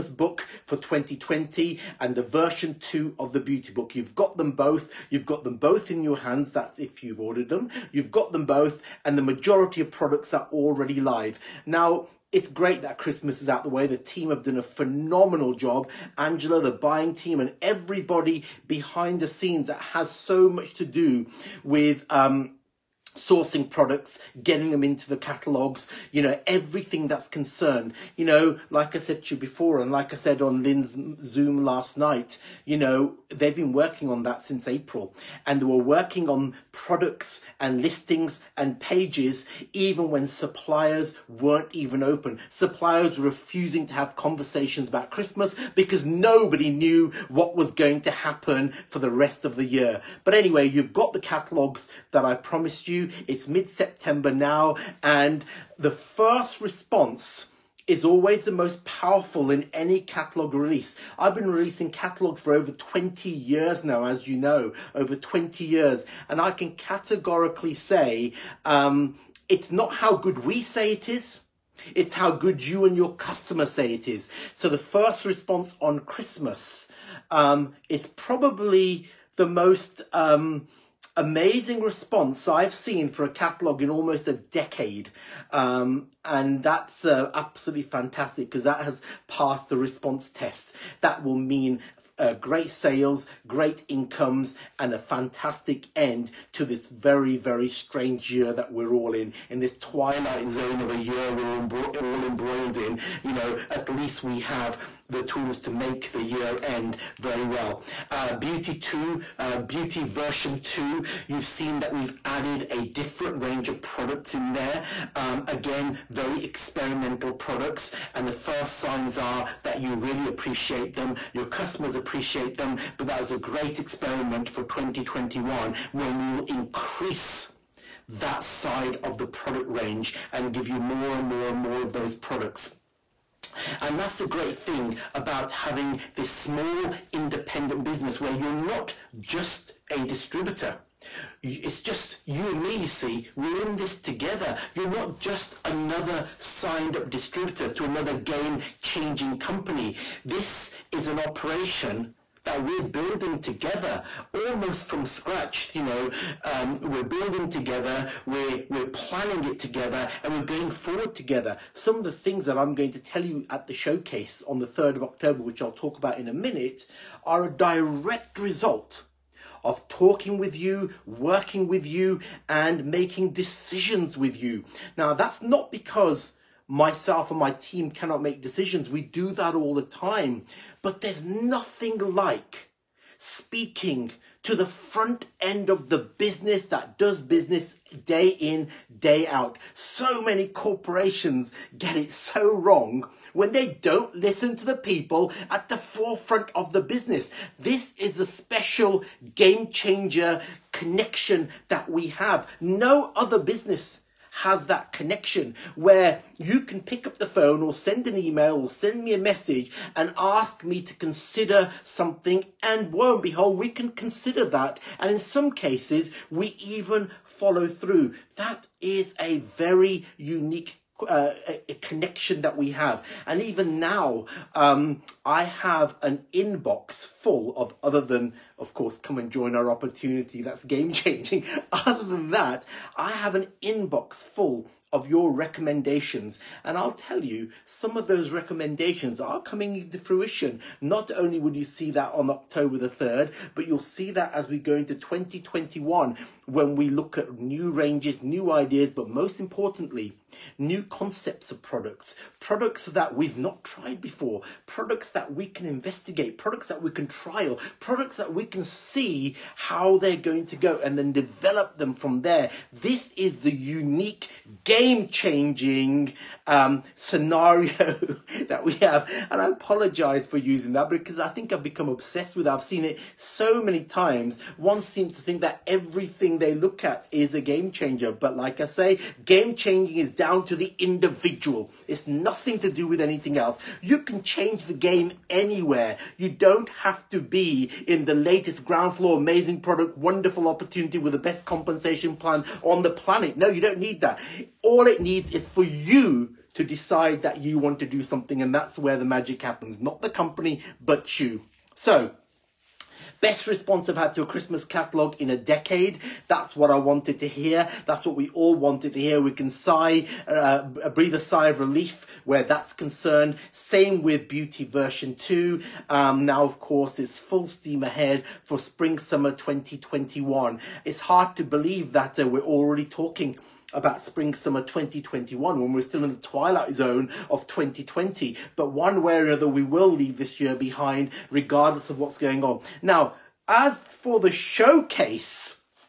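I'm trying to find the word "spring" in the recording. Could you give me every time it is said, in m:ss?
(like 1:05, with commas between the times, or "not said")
5:18, 5:24.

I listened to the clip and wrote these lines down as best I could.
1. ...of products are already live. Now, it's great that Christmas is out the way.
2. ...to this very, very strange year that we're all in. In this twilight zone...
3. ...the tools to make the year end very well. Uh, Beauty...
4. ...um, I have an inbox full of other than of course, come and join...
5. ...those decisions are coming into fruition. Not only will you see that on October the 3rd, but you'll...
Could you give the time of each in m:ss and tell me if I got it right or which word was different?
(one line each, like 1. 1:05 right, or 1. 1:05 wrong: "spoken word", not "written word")
1. 0:09 right
2. 1:36 right
3. 1:45 right
4. 3:44 right
5. 3:58 wrong: "recommendations", not "decisions".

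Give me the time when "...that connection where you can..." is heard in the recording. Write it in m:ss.
3:24.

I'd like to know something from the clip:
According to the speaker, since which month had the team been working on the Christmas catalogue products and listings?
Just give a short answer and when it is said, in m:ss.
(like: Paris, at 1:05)
April, at 0:34.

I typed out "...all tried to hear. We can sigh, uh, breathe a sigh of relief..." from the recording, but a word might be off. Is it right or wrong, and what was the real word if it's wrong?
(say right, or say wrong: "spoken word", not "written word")
wrong: "wanted", not "tried".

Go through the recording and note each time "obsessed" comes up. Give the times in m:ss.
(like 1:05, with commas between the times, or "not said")
4:31.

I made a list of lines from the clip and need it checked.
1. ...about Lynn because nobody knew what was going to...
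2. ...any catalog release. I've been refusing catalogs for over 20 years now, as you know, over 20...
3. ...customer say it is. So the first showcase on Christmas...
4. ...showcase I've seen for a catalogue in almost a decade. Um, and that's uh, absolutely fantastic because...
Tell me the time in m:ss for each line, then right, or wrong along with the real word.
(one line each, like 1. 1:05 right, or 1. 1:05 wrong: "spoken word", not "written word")
1. 0:44 wrong: "Christmas", not "Lynn"
2. 0:59 wrong: "releasing", not "refusing"
3. 1:13 wrong: "response", not "showcase"
4. 1:21 wrong: "response", not "showcase".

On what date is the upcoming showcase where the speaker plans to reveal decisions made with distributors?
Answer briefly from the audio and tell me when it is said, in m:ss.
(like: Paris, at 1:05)
3 October, at 2:44.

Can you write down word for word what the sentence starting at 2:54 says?
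Now, that's not because myself and my team cannot make decisions.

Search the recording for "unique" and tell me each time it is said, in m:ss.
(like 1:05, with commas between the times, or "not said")
3:40, 4:23.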